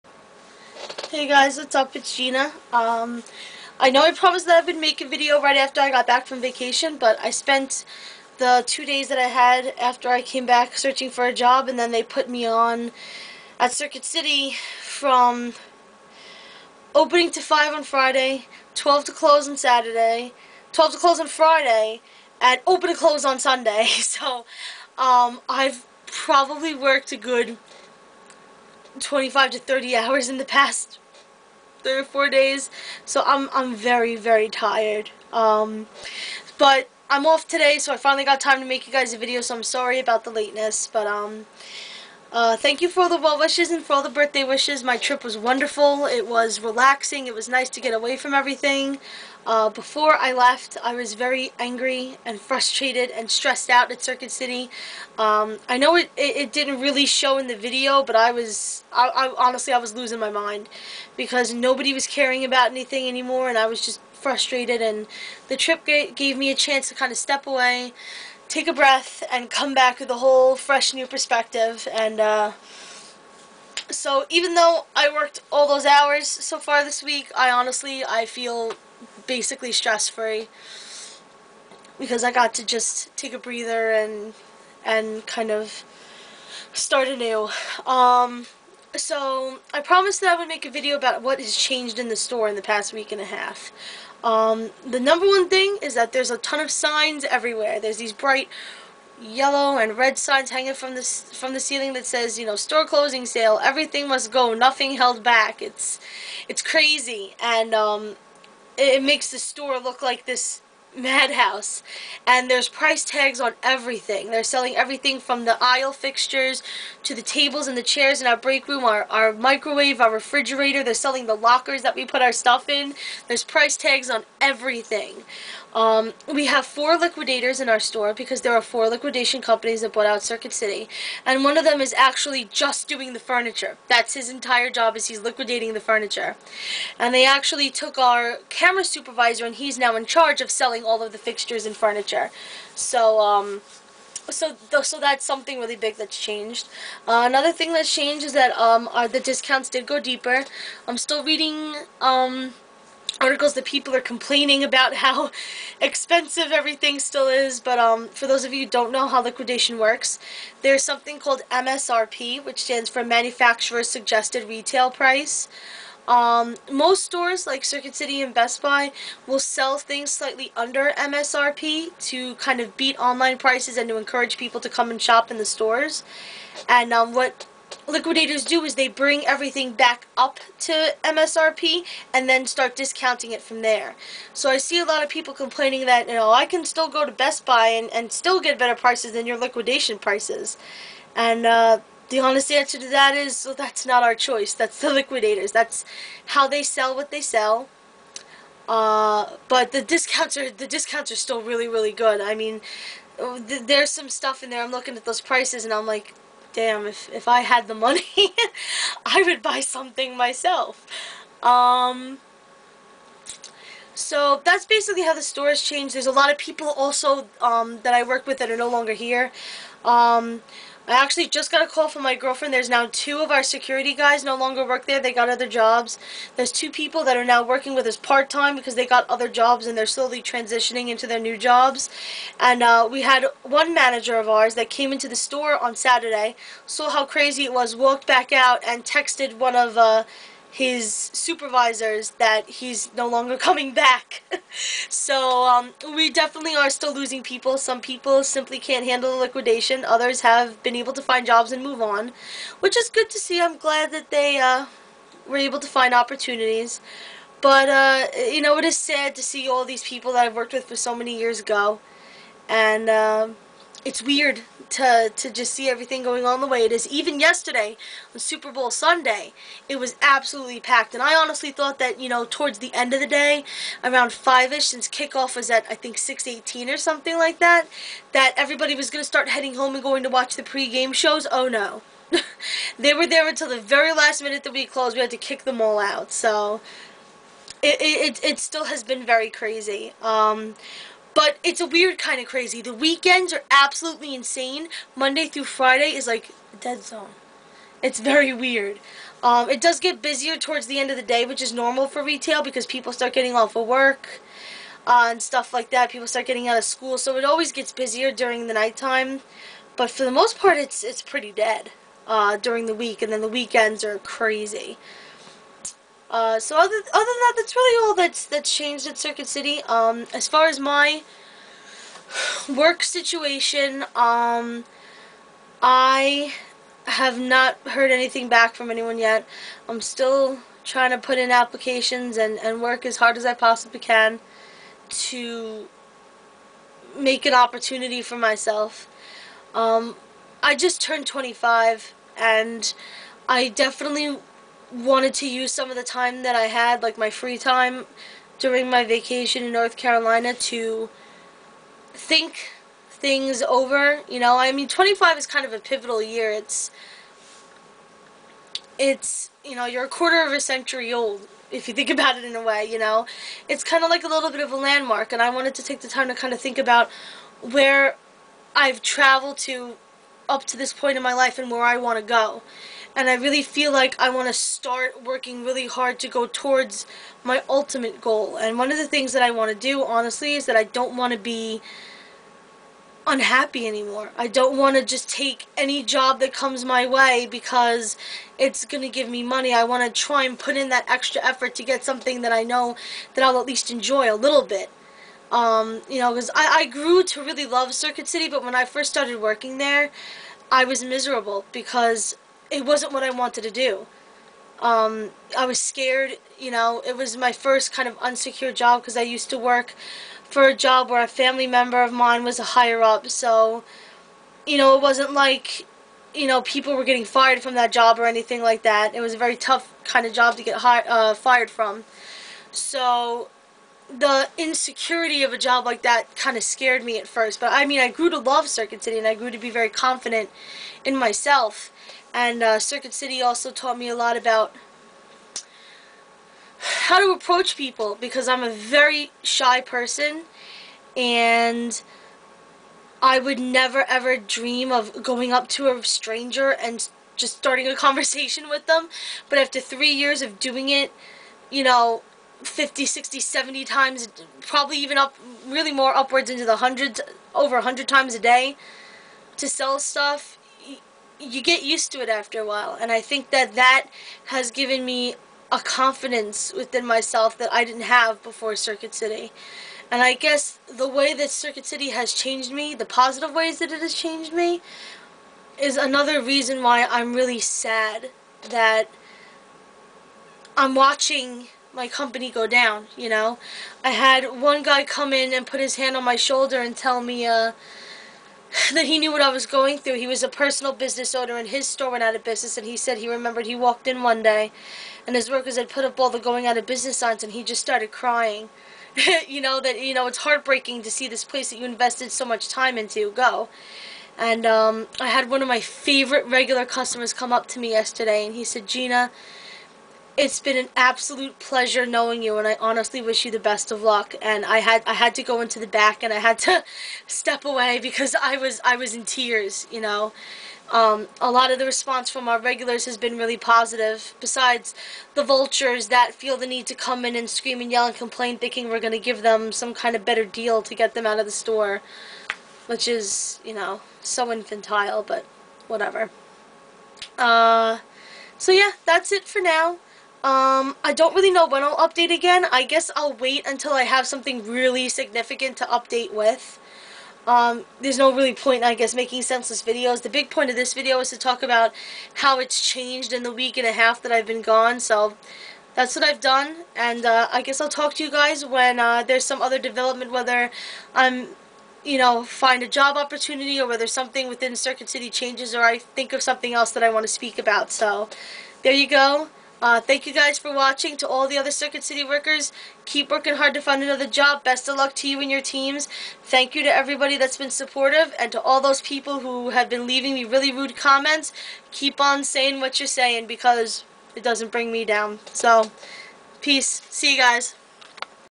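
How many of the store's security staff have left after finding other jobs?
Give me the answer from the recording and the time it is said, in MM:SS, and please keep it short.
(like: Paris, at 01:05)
2, at 03:42.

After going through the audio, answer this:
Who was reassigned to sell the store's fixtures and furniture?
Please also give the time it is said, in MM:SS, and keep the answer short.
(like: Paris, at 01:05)
camera supervisor, at 02:18.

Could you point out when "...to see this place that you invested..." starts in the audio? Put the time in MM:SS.
08:20.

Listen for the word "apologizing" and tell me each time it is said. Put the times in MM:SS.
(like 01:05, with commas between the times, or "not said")
not said.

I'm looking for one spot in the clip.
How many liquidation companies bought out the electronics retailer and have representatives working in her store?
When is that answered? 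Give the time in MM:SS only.
02:08.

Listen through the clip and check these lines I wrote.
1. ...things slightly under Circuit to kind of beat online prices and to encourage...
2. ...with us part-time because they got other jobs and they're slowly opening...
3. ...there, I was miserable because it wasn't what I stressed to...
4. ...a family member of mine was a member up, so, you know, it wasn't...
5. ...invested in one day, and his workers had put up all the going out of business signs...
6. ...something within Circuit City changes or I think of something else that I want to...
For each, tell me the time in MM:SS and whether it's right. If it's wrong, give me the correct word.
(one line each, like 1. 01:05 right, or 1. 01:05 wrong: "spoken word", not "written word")
1. 02:49 wrong: "MSRP", not "Circuit"
2. 03:47 wrong: "transitioning", not "opening"
3. 06:39 wrong: "wanted", not "stressed"
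4. 06:51 wrong: "higher", not "member"
5. 08:13 wrong: "walked", not "invested"
6. 09:23 right.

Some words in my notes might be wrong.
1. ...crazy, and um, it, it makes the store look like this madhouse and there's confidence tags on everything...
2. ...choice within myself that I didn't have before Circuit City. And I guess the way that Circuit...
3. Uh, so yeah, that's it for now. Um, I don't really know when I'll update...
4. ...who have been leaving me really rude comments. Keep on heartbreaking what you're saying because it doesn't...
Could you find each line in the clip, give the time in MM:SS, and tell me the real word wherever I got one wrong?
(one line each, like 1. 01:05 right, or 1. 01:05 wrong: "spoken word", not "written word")
1. 01:46 wrong: "price", not "confidence"
2. 07:45 wrong: "confidence", not "choice"
3. 08:57 right
4. 09:39 wrong: "saying", not "heartbreaking".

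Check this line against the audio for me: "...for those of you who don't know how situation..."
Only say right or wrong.
wrong.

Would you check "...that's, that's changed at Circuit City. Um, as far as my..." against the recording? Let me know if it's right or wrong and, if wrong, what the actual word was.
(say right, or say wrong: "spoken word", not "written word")
right.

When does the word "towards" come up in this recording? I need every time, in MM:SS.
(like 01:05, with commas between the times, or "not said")
04:32, 05:00, 06:16.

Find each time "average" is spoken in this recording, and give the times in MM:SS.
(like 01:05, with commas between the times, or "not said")
not said.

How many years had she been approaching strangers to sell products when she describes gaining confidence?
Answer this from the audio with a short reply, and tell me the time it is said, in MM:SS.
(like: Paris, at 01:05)
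3, at 07:29.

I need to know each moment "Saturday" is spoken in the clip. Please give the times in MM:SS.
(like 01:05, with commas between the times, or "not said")
00:19, 03:55.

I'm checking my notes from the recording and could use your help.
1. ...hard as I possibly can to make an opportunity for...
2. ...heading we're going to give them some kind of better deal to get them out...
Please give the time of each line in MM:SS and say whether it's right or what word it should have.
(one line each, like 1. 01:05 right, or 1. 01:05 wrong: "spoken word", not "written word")
1. 05:32 right
2. 08:48 wrong: "thinking", not "heading".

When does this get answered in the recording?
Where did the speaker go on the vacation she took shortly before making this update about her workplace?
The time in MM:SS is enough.
05:49.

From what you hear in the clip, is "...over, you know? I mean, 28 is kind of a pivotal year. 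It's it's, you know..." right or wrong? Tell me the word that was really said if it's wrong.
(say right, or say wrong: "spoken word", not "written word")
wrong: "25", not "28".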